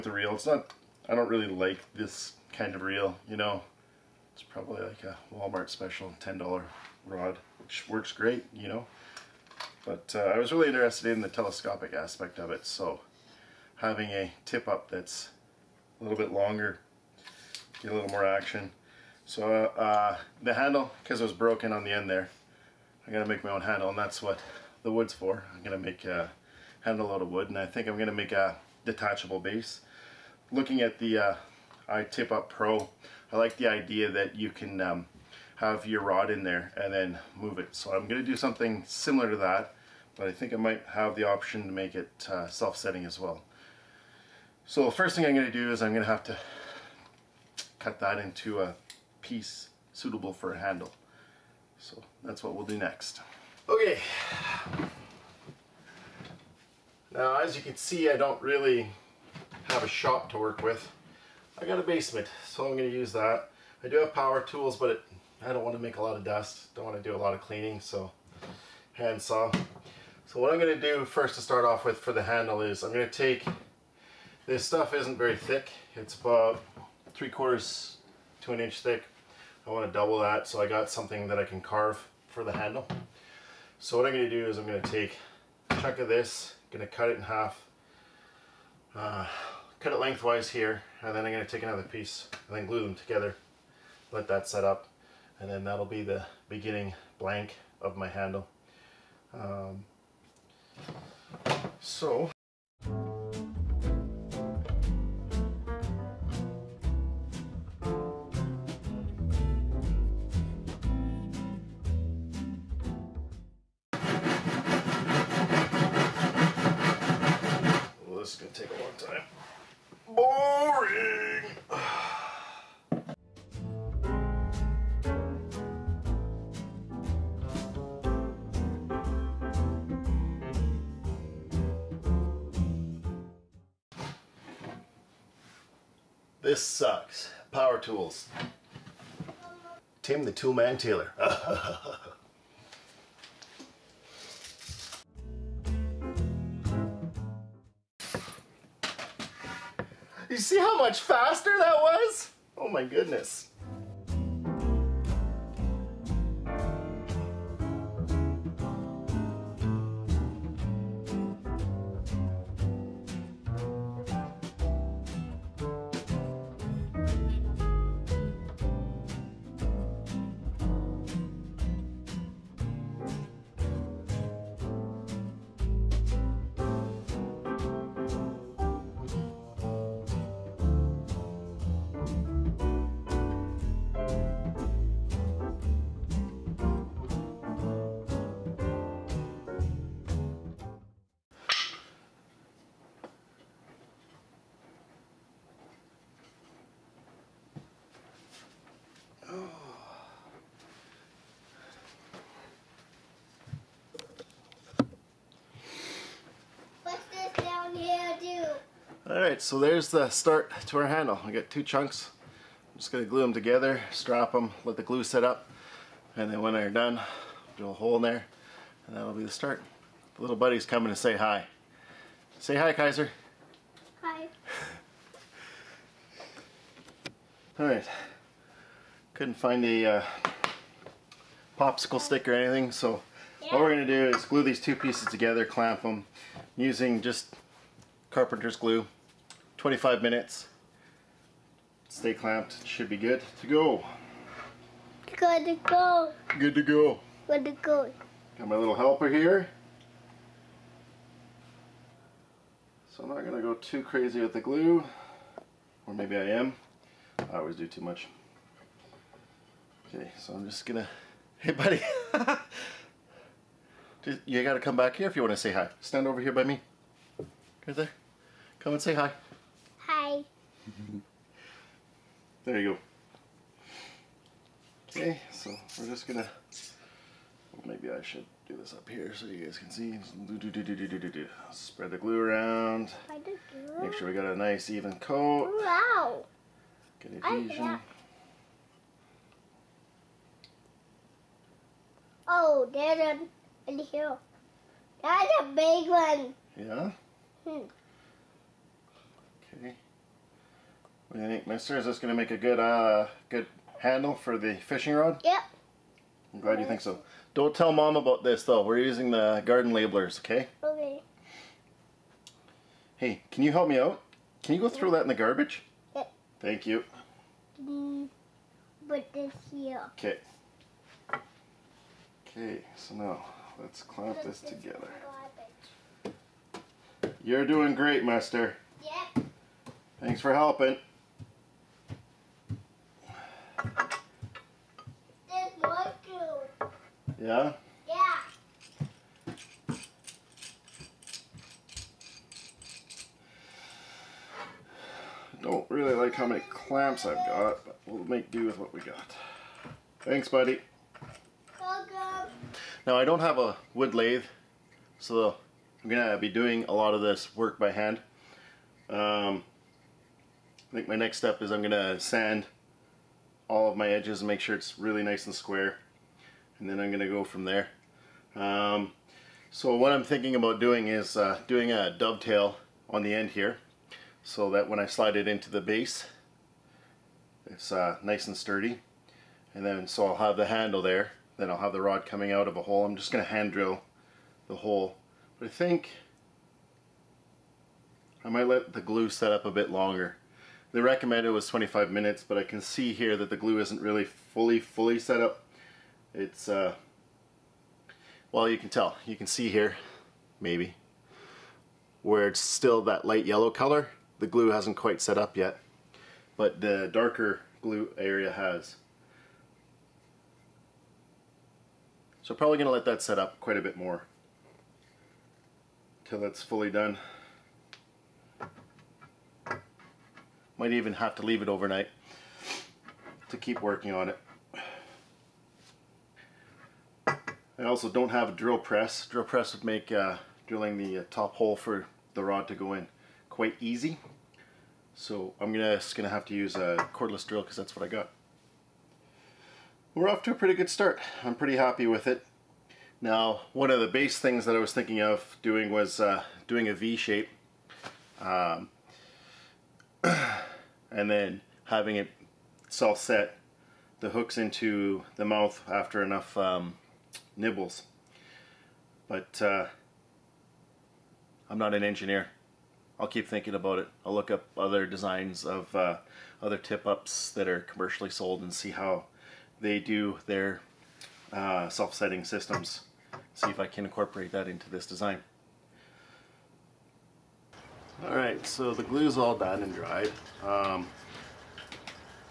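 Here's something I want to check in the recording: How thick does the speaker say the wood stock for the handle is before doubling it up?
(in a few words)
three quarters to an inch.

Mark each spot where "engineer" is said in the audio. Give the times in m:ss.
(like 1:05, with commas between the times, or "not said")
7:41.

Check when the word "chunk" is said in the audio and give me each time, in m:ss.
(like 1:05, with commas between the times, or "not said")
1:25, 3:31.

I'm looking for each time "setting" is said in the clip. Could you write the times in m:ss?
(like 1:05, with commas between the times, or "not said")
0:42, 7:51.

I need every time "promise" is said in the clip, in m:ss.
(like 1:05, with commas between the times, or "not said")
not said.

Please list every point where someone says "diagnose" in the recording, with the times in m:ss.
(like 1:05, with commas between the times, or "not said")
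not said.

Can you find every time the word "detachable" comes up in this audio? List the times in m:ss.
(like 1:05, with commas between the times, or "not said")
0:28.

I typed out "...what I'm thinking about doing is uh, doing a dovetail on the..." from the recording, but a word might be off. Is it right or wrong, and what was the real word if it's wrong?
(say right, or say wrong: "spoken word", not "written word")
right.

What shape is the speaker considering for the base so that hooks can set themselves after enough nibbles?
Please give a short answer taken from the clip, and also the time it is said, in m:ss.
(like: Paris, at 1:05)
V shape, at 7:26.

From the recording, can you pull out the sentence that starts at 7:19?
We're off to a pretty good start.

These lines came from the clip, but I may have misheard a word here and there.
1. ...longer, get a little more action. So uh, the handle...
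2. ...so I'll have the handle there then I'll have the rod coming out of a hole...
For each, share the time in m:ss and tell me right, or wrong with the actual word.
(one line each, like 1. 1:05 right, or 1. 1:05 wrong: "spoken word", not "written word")
1. 0:16 right
2. 6:19 right.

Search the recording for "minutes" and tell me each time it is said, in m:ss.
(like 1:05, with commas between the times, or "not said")
3:59, 6:31.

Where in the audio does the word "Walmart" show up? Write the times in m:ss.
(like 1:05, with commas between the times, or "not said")
0:05.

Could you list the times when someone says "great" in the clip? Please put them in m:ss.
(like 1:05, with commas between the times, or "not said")
0:08, 5:27.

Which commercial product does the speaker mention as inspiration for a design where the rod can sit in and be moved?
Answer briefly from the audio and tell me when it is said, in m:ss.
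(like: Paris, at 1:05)
iTip Up Pro, at 0:31.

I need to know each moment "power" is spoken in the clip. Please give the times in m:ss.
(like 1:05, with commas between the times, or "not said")
1:04, 2:17.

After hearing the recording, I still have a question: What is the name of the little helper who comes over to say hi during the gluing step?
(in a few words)
Kaiser.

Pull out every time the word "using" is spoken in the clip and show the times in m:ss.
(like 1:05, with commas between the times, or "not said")
3:56, 5:08.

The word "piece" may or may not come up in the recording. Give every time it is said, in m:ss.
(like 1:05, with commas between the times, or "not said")
0:49, 1:31, 3:54.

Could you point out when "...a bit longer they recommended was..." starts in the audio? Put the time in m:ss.
6:29.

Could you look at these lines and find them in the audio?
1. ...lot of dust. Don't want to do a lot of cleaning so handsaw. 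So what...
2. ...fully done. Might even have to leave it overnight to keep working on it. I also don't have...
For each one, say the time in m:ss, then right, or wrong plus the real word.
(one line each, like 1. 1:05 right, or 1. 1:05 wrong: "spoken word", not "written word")
1. 1:06 right
2. 6:56 right.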